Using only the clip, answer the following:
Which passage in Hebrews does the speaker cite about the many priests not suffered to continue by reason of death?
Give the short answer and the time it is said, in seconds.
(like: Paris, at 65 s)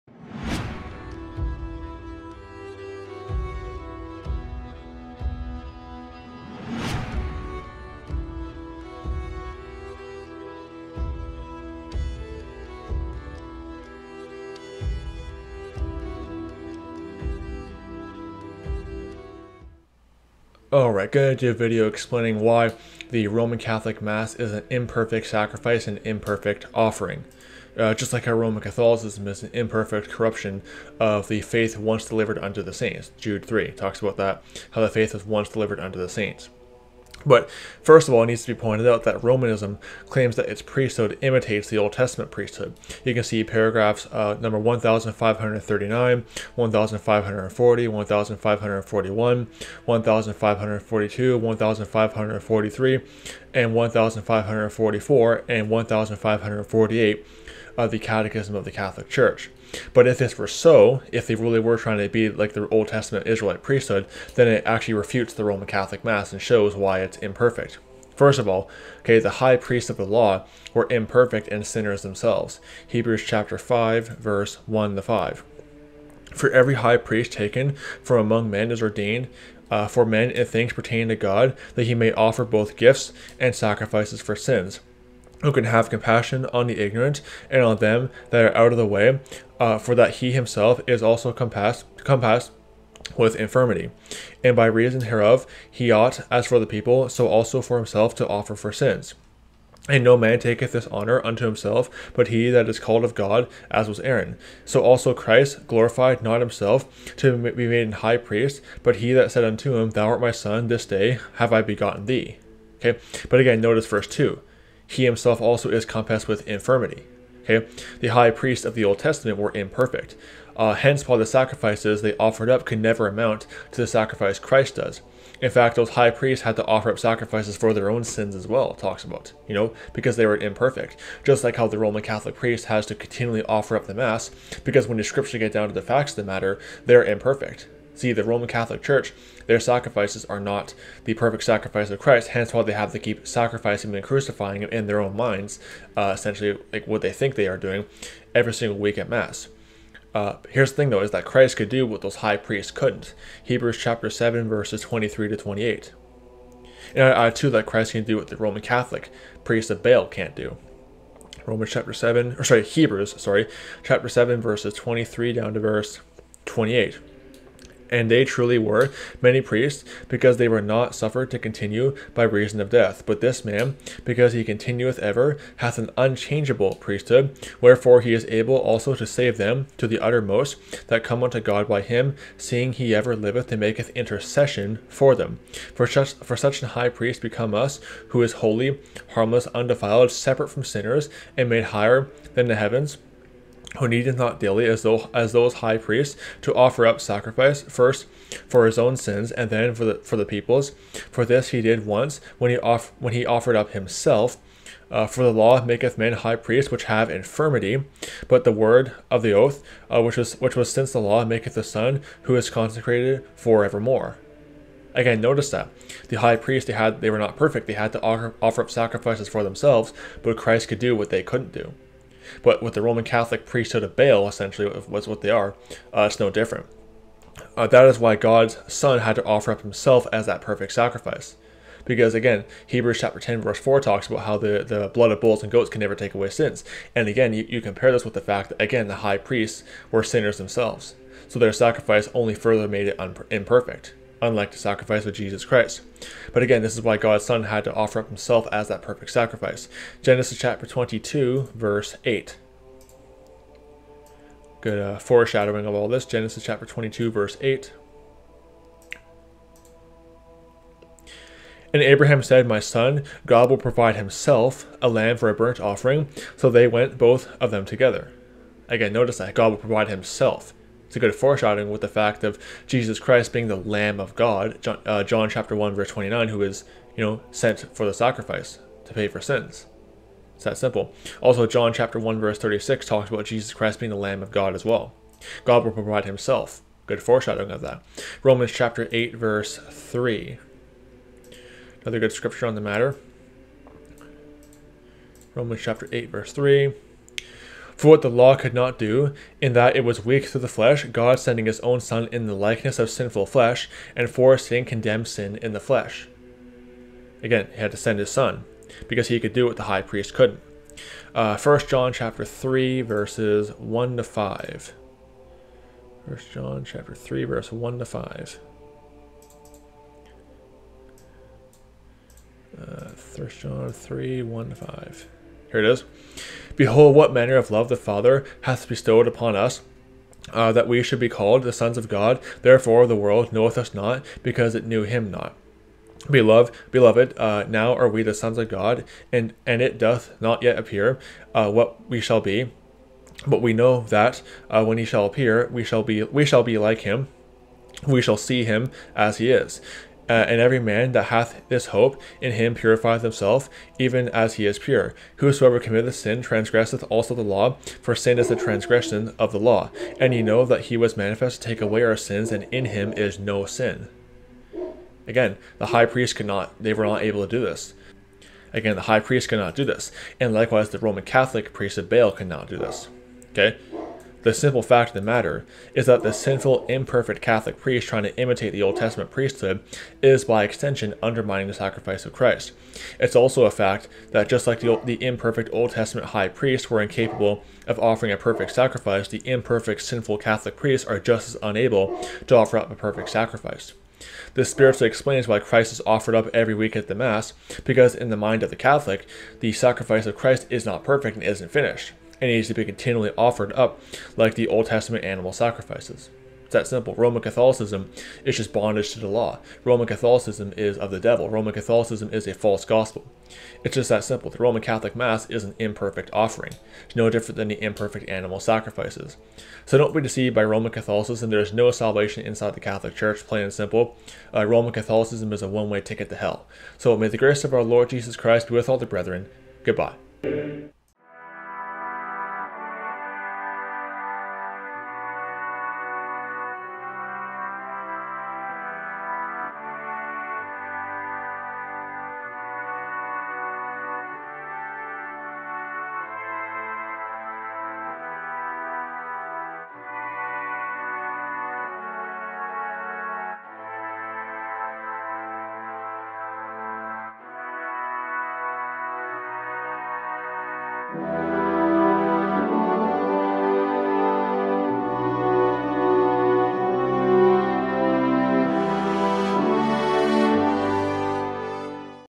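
Hebrews 7:23-28, at 153 s.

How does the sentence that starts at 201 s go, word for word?
For this he did once when he off when he offered up himself.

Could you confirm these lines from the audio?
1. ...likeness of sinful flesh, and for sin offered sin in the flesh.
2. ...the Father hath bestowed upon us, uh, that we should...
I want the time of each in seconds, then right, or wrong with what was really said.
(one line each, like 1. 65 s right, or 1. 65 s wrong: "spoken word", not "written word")
1. 302 s wrong: "condemned", not "offered"
2. 327 s right.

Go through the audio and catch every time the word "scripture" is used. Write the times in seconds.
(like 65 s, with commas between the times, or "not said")
135 s, 292 s.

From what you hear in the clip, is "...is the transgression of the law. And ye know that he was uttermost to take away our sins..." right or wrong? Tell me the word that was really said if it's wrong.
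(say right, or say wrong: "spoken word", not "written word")
wrong: "manifest", not "uttermost".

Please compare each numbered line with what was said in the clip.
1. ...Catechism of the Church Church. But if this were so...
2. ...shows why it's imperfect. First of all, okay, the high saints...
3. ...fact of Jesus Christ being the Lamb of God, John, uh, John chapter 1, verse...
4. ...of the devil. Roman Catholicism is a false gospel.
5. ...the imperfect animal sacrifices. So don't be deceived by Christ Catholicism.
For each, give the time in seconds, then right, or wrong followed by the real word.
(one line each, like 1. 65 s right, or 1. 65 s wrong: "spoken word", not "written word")
1. 57 s wrong: "Catholic", not "Church"
2. 66 s wrong: "priests", not "saints"
3. 271 s right
4. 410 s right
5. 417 s wrong: "Roman", not "Christ".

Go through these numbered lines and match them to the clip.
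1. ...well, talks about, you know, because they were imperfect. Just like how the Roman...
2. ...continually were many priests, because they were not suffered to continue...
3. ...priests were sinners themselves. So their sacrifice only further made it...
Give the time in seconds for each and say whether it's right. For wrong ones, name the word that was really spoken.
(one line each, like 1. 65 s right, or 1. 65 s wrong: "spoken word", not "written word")
1. 128 s right
2. 168 s wrong: "truly", not "continually"
3. 239 s right.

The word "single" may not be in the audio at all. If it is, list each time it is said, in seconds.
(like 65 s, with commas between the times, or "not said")
148 s.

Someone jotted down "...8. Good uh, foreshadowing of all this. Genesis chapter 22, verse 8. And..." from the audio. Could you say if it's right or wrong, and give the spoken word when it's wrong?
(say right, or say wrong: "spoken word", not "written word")
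right.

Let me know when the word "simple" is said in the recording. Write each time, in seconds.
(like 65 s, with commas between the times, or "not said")
280 s, 374 s, 406 s, 414 s, 423 s.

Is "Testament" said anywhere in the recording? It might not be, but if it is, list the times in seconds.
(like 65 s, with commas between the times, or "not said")
62 s, 118 s, 378 s, 385 s, 404 s.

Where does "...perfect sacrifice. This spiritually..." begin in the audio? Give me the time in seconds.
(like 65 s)
392 s.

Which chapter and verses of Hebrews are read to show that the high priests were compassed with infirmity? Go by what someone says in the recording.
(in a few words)
Hebrews 5:1-5.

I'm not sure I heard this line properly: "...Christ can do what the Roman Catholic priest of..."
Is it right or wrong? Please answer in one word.
right.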